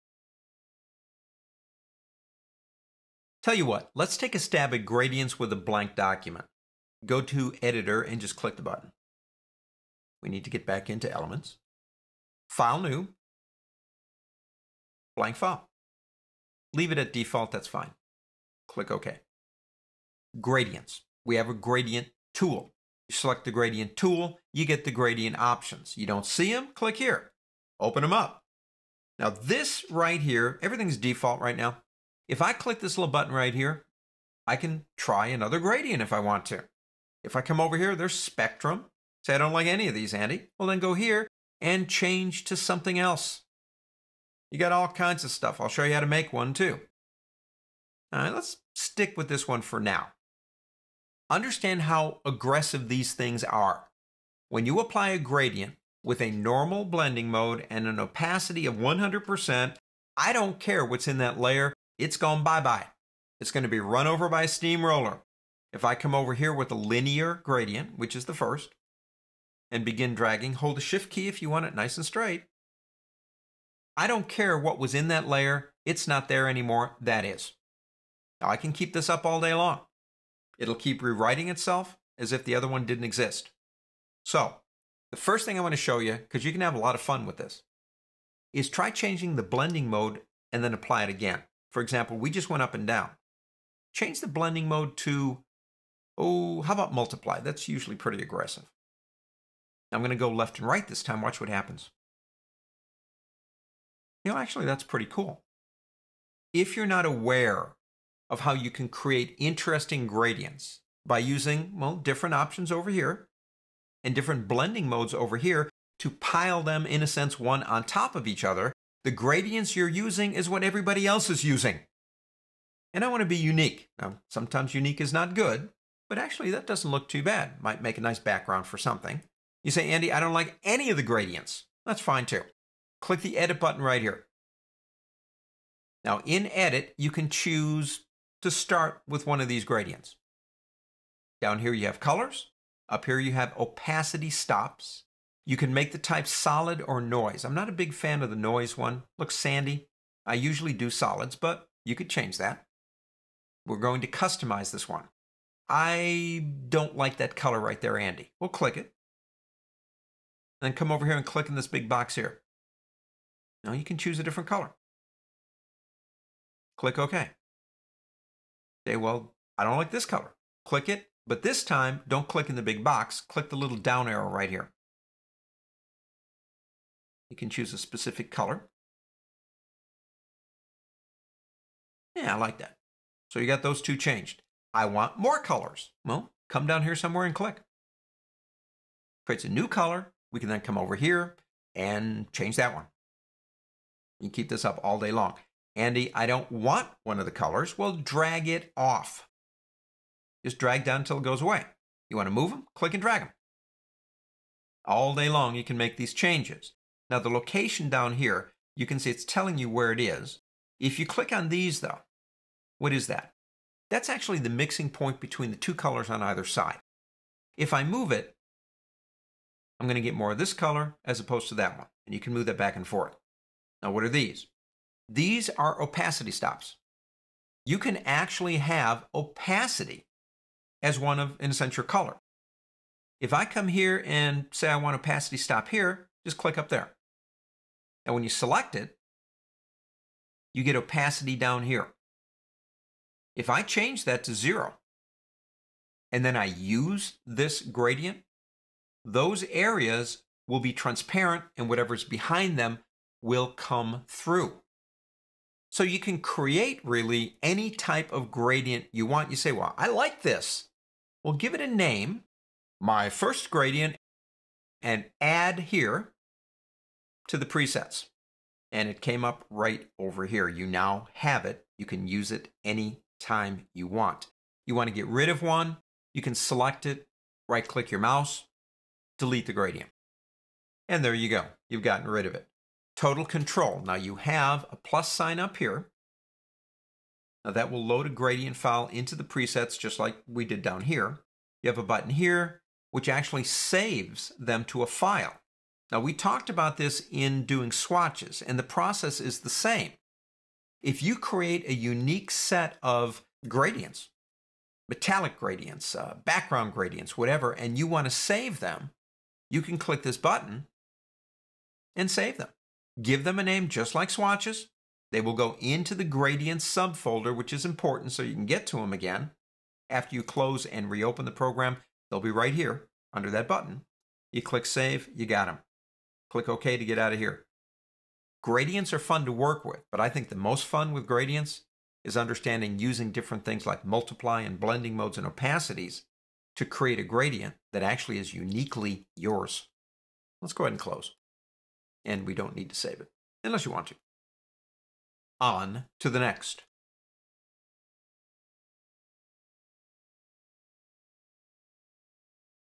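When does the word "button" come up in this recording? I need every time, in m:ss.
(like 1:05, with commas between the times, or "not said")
0:08, 0:33, 2:13, 4:51, 5:10, 5:23.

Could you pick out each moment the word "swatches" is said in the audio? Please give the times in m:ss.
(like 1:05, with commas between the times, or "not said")
4:57, 5:14.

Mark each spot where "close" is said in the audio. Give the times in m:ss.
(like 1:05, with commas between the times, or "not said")
5:20, 5:40.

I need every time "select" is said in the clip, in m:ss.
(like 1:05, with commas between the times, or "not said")
0:23, 3:58, 4:36.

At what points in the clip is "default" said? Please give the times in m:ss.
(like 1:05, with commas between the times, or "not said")
0:17, 0:30.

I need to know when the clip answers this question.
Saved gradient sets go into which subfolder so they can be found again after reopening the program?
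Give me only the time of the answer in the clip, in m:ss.
5:16.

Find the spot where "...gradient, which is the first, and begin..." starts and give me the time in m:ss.
1:07.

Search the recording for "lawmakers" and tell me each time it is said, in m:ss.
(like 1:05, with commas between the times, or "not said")
not said.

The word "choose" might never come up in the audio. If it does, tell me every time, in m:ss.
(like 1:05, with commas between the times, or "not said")
2:17, 2:43, 2:57.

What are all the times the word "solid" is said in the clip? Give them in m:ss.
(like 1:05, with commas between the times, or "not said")
2:26, 2:30.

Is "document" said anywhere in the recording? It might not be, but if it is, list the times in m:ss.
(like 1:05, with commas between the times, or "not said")
0:05.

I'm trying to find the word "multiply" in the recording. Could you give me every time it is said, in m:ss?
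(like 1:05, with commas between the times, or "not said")
1:36, 5:33.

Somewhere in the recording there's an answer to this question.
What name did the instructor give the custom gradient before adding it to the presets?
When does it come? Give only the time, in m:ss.
4:22.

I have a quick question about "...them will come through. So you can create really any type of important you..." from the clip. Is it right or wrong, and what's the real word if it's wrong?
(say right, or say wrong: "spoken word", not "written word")
wrong: "gradient", not "important".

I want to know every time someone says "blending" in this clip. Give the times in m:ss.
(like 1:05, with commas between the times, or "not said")
0:56, 1:29, 1:34, 1:54, 5:34.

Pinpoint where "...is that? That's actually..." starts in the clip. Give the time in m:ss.
3:32.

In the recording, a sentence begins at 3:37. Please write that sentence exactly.
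If I move it, I'm going to get more of this color as opposed to that one.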